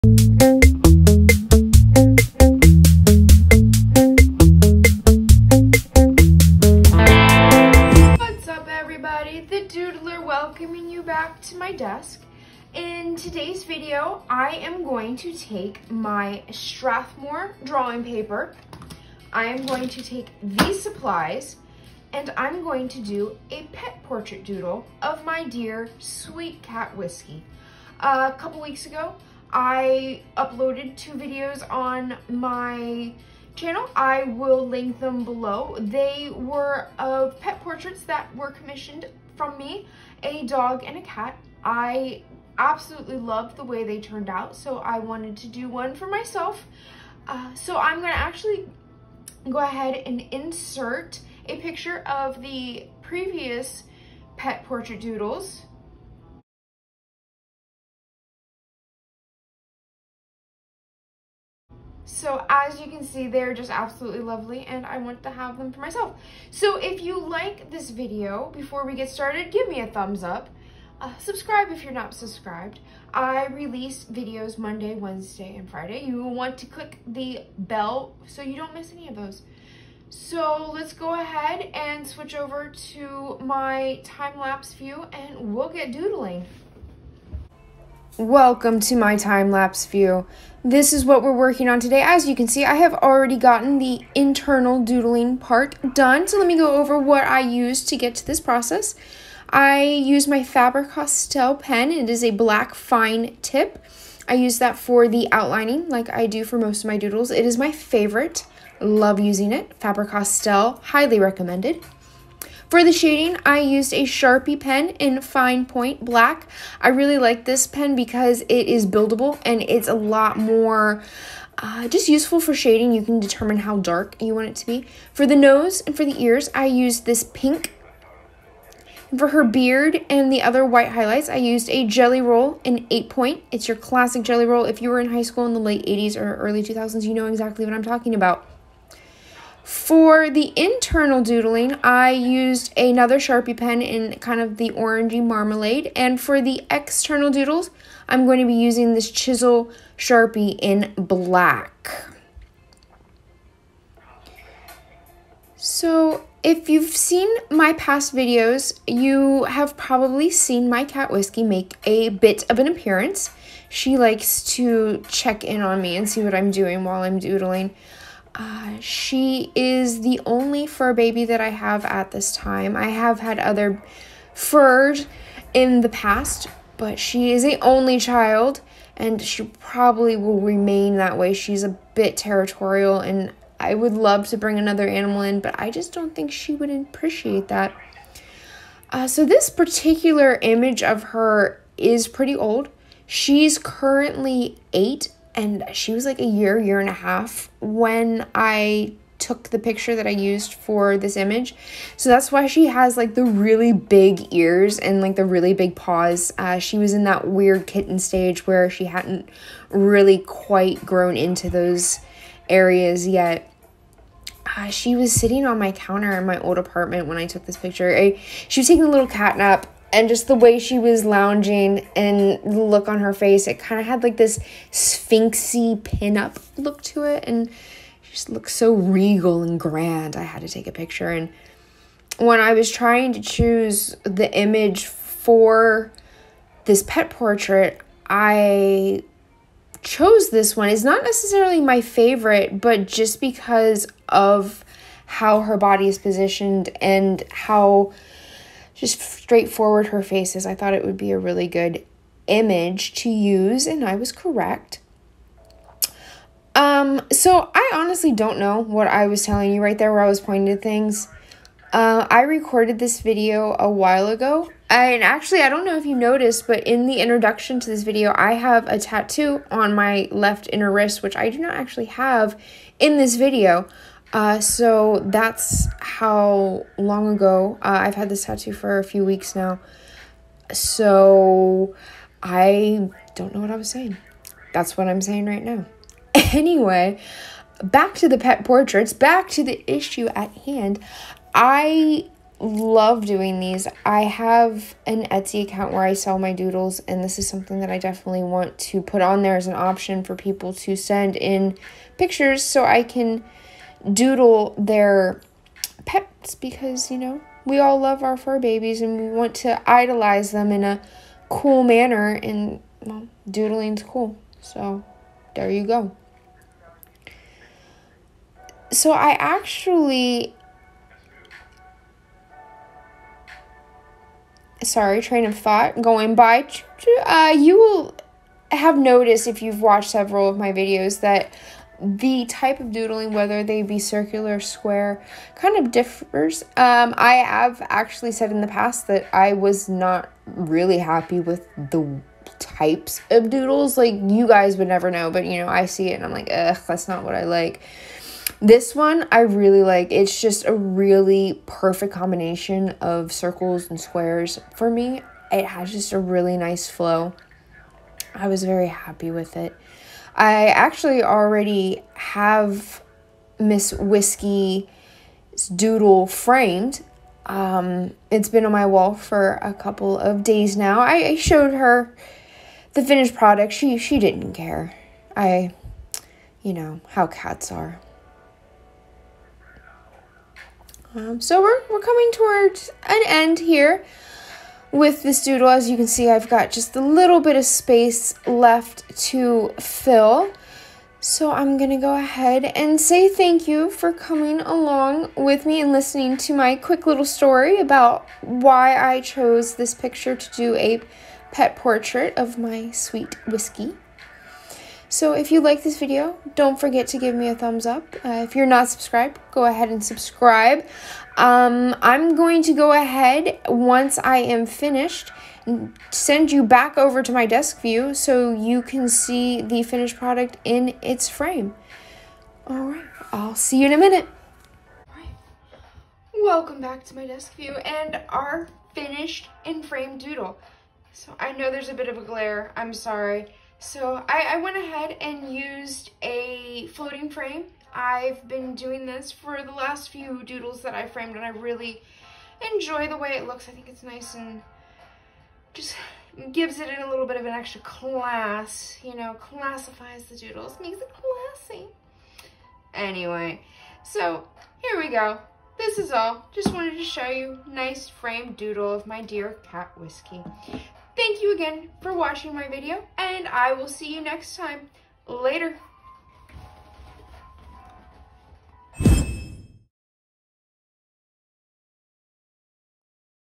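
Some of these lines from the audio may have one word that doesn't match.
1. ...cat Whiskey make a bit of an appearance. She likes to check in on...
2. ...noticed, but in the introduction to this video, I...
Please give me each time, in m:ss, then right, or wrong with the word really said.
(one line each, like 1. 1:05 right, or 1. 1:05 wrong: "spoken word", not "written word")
1. 2:40 right
2. 4:25 right.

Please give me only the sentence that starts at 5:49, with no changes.
It's just a really perfect combination of circles and squares for me.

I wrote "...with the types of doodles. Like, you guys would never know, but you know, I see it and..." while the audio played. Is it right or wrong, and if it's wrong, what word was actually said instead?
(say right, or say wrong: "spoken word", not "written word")
right.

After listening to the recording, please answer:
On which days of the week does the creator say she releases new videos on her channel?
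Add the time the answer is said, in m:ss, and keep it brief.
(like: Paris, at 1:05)
Monday, Wednesday, and Friday, at 1:14.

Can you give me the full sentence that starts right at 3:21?
So that's why she has like the really big ears and like the really big paws.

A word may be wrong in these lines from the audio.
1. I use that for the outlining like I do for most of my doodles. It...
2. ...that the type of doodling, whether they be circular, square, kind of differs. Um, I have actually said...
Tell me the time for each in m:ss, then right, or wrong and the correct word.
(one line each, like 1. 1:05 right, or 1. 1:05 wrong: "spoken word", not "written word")
1. 1:44 right
2. 5:31 right.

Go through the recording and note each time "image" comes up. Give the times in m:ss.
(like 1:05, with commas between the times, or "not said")
3:10, 3:21, 3:54, 4:12.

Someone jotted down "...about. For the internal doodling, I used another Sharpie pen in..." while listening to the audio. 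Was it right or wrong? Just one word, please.
right.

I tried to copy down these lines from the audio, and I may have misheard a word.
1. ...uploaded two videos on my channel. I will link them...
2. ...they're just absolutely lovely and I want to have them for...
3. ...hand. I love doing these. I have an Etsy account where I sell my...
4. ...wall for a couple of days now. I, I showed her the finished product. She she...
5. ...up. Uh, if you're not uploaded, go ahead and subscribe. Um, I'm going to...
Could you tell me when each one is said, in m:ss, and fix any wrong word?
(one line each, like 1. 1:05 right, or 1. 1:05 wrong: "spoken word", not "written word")
1. 0:30 right
2. 1:03 right
3. 4:50 right
4. 6:08 right
5. 6:47 wrong: "subscribed", not "uploaded".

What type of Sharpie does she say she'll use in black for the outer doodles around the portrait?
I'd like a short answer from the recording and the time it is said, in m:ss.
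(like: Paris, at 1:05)
chisel Sharpie, at 2:29.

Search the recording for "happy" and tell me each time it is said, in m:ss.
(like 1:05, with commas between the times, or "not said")
5:40, 5:58.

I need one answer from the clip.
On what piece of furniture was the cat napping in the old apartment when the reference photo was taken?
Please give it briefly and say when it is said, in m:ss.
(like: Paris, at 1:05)
counter, at 3:35.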